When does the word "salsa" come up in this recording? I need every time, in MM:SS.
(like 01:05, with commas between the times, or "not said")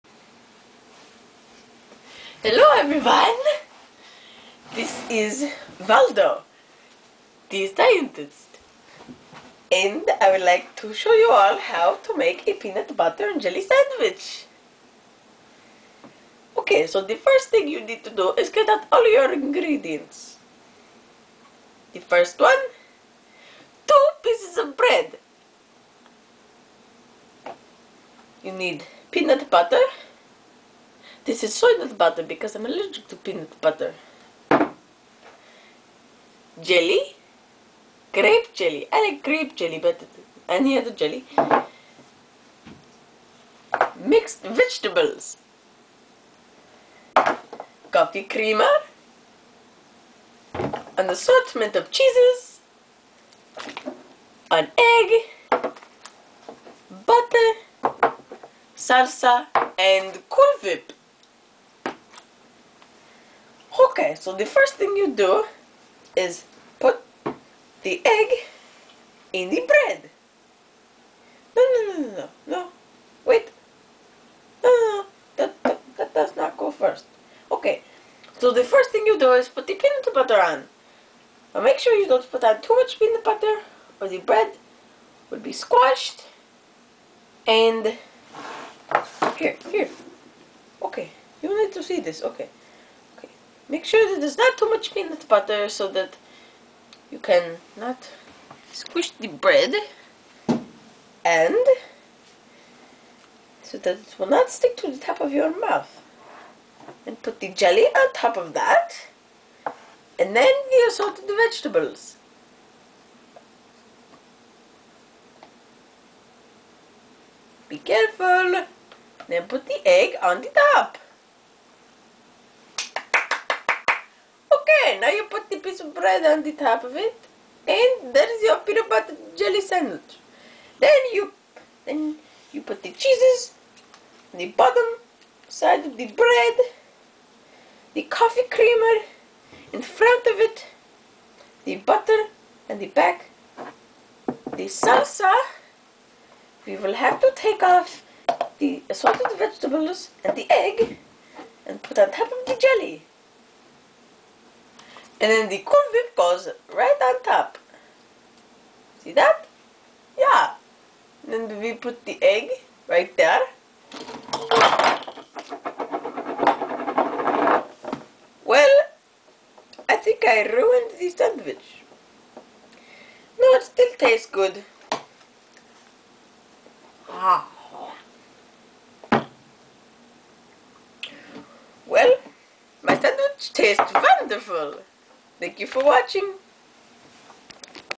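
00:58, 02:24.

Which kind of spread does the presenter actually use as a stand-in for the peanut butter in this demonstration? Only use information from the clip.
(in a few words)
soy nut butter.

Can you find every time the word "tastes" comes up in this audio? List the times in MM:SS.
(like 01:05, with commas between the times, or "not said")
02:53, 03:03.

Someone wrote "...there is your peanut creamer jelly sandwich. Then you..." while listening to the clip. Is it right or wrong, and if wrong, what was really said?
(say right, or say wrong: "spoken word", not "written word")
wrong: "butter", not "creamer".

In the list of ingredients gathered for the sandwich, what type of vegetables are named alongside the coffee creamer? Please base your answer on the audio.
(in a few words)
mixed vegetables.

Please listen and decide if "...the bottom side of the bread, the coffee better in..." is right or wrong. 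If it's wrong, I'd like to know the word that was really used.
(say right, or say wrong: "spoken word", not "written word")
wrong: "creamer", not "better".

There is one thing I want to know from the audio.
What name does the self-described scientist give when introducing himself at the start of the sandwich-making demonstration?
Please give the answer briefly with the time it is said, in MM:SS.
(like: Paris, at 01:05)
Waldo, at 00:05.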